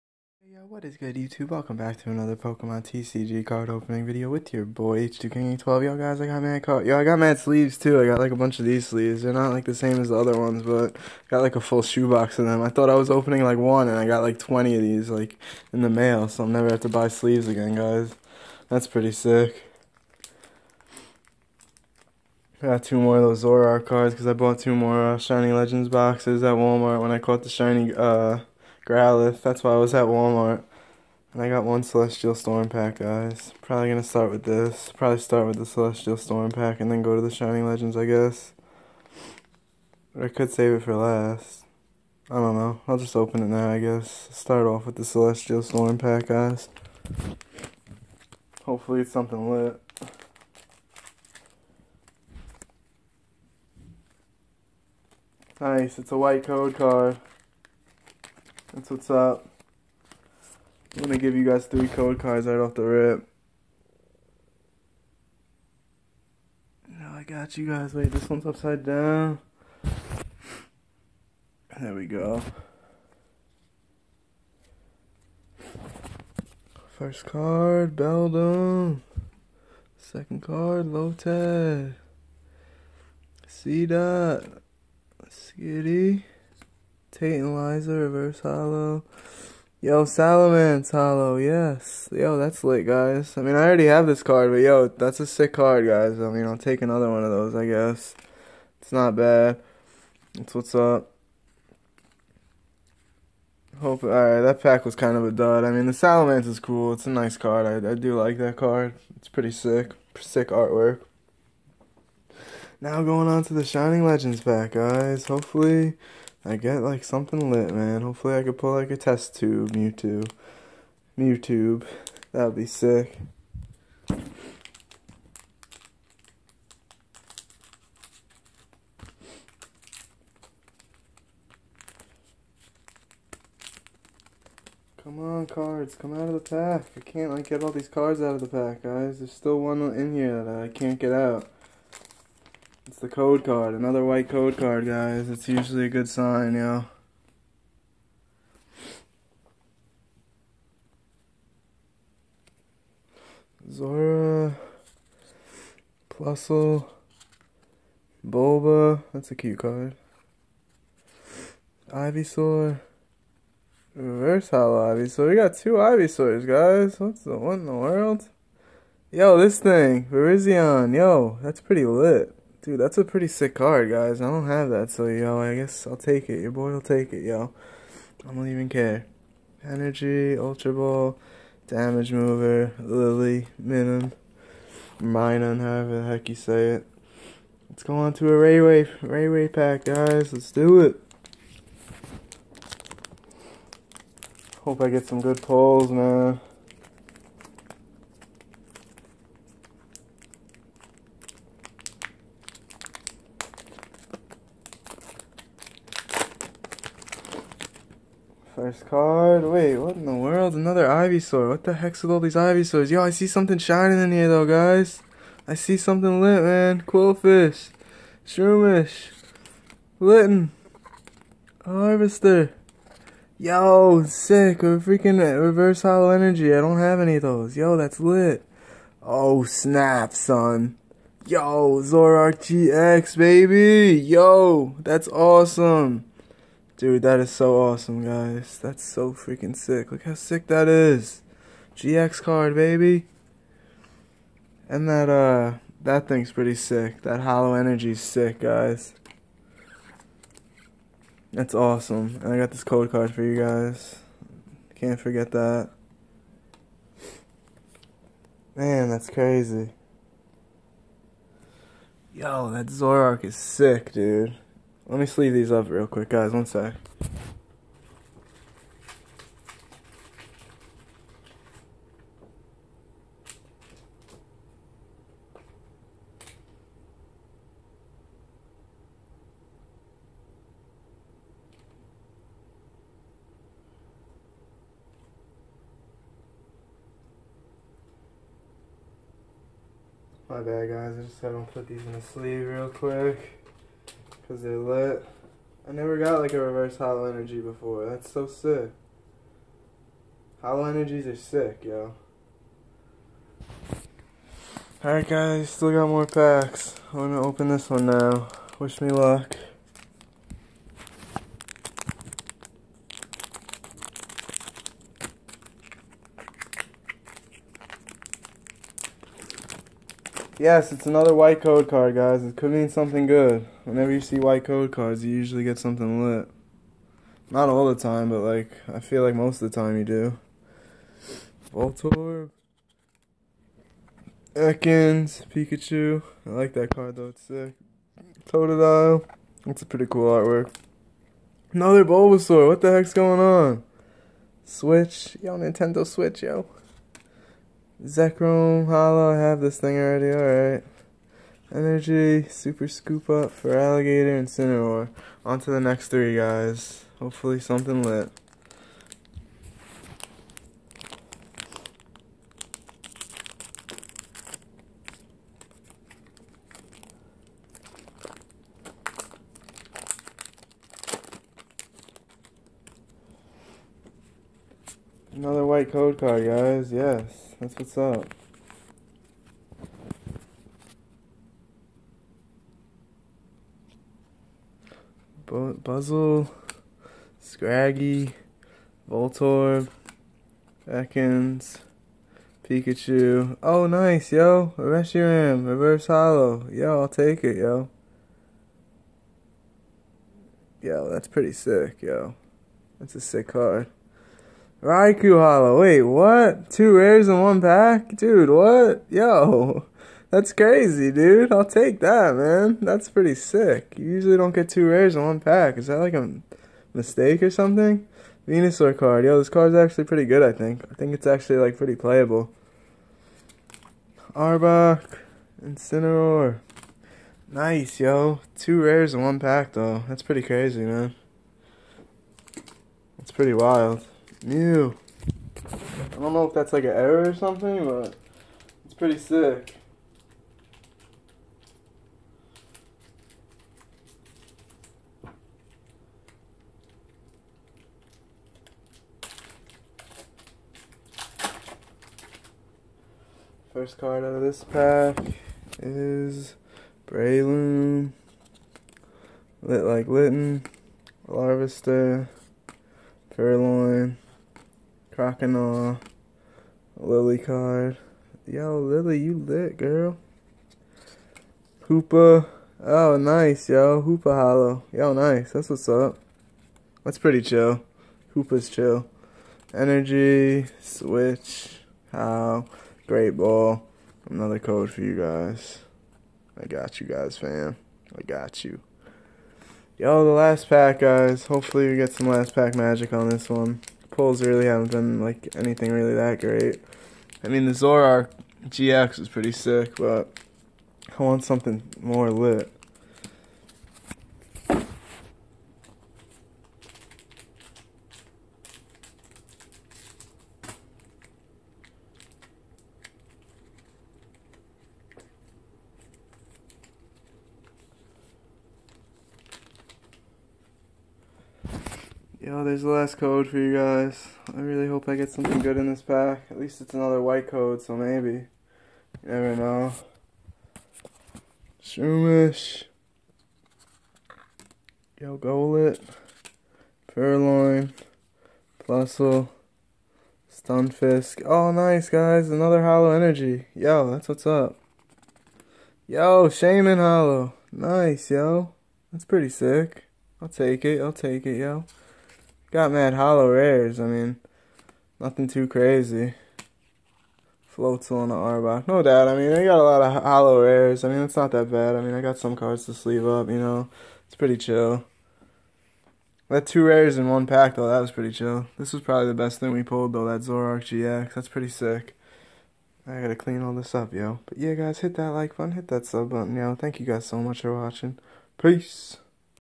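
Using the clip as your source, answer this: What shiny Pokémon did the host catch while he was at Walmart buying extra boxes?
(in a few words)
Growlithe.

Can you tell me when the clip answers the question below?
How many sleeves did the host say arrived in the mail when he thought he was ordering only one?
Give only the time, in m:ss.
0:14.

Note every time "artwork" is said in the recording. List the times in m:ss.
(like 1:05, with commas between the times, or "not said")
1:50, 5:40.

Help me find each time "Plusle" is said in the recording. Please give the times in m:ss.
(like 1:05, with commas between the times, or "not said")
2:36, 8:58.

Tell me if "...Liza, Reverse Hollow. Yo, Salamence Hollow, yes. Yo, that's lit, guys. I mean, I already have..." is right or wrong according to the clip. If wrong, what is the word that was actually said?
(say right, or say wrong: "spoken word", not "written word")
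right.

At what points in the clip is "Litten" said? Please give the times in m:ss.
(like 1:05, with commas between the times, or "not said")
3:39, 7:39.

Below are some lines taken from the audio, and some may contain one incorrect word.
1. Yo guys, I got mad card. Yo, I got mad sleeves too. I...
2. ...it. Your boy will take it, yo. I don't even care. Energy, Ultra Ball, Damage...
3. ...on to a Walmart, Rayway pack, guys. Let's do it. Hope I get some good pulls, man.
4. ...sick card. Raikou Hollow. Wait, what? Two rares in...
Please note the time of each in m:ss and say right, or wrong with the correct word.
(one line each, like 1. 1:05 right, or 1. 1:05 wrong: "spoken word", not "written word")
1. 0:05 right
2. 2:56 right
3. 3:07 wrong: "Rayway", not "Walmart"
4. 6:43 right.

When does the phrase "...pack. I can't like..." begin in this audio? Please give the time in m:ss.
2:16.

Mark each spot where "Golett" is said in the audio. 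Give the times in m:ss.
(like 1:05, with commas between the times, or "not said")
8:55.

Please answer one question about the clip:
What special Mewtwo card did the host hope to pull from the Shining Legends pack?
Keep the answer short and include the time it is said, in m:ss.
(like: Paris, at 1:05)
test tube Mewtwo, at 1:58.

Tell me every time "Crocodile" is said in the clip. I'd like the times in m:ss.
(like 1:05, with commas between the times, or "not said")
7:44.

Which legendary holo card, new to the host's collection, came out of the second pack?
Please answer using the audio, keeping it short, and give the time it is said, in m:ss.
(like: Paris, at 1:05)
Virizion, at 2:50.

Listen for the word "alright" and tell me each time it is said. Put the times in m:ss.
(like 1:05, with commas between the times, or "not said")
1:44, 5:04, 5:50.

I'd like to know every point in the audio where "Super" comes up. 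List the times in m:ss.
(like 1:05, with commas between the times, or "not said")
5:52.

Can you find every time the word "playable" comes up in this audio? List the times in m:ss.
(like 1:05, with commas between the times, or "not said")
7:01.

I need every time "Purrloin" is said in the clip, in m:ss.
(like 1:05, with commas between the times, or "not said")
7:43, 8:56.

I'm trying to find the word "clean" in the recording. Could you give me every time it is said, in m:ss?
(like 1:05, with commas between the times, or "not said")
9:33.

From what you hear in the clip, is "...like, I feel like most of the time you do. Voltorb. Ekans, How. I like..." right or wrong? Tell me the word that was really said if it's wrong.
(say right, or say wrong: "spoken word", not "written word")
wrong: "Pikachu", not "How".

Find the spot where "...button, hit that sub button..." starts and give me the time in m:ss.
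9:35.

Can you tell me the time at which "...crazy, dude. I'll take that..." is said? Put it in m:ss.
6:50.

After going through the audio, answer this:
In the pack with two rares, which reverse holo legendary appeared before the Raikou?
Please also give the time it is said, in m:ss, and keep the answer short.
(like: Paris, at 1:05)
Reshiram, at 6:34.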